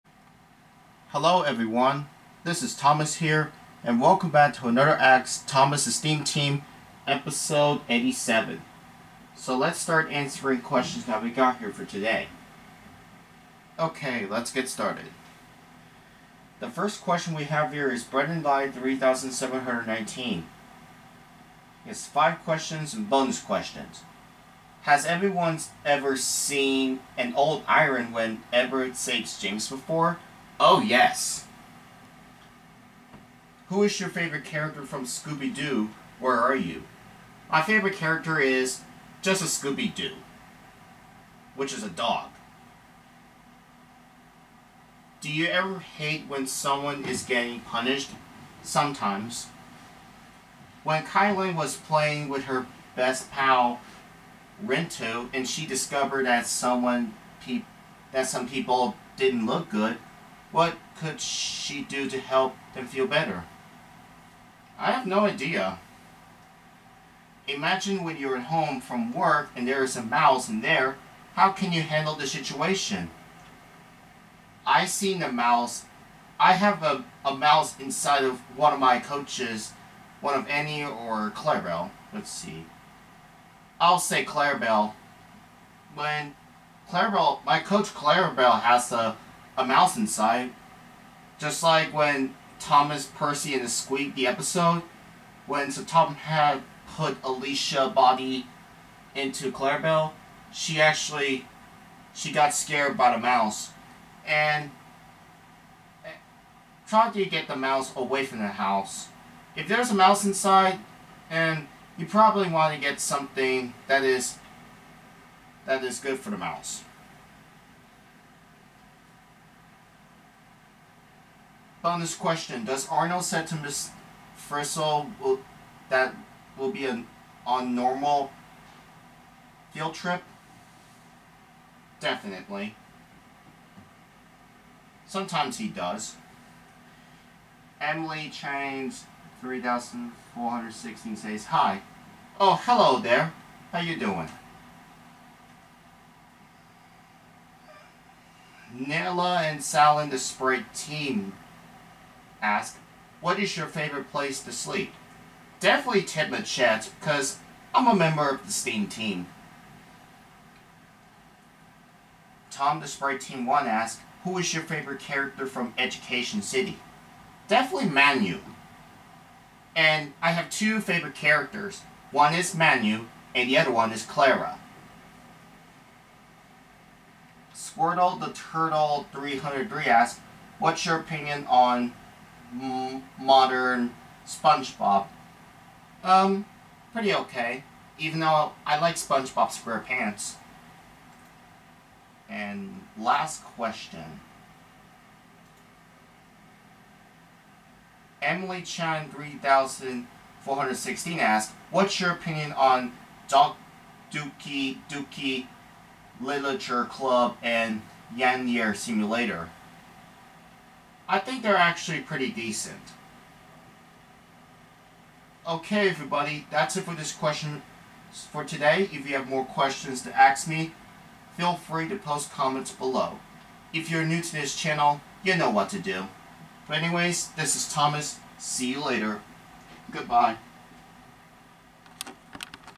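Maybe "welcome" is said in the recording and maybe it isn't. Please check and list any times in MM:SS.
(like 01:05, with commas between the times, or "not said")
00:03.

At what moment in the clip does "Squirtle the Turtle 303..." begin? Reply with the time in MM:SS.
02:57.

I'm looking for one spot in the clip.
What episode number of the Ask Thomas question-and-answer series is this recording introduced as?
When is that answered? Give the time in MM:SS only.
00:07.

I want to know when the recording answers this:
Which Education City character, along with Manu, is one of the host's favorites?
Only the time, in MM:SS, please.
02:54.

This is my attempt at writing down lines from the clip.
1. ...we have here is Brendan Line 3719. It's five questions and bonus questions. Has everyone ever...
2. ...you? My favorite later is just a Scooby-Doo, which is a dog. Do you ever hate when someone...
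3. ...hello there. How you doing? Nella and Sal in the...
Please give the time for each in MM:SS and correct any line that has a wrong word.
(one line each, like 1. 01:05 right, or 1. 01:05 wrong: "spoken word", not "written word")
1. 00:17 right
2. 00:36 wrong: "character", not "later"
3. 02:22 right.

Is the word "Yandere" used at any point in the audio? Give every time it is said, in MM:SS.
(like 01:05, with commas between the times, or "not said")
03:28.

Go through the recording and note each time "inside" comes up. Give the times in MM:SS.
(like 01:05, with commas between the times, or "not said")
01:17, 01:29, 01:50.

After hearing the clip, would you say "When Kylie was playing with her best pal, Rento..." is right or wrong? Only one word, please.
right.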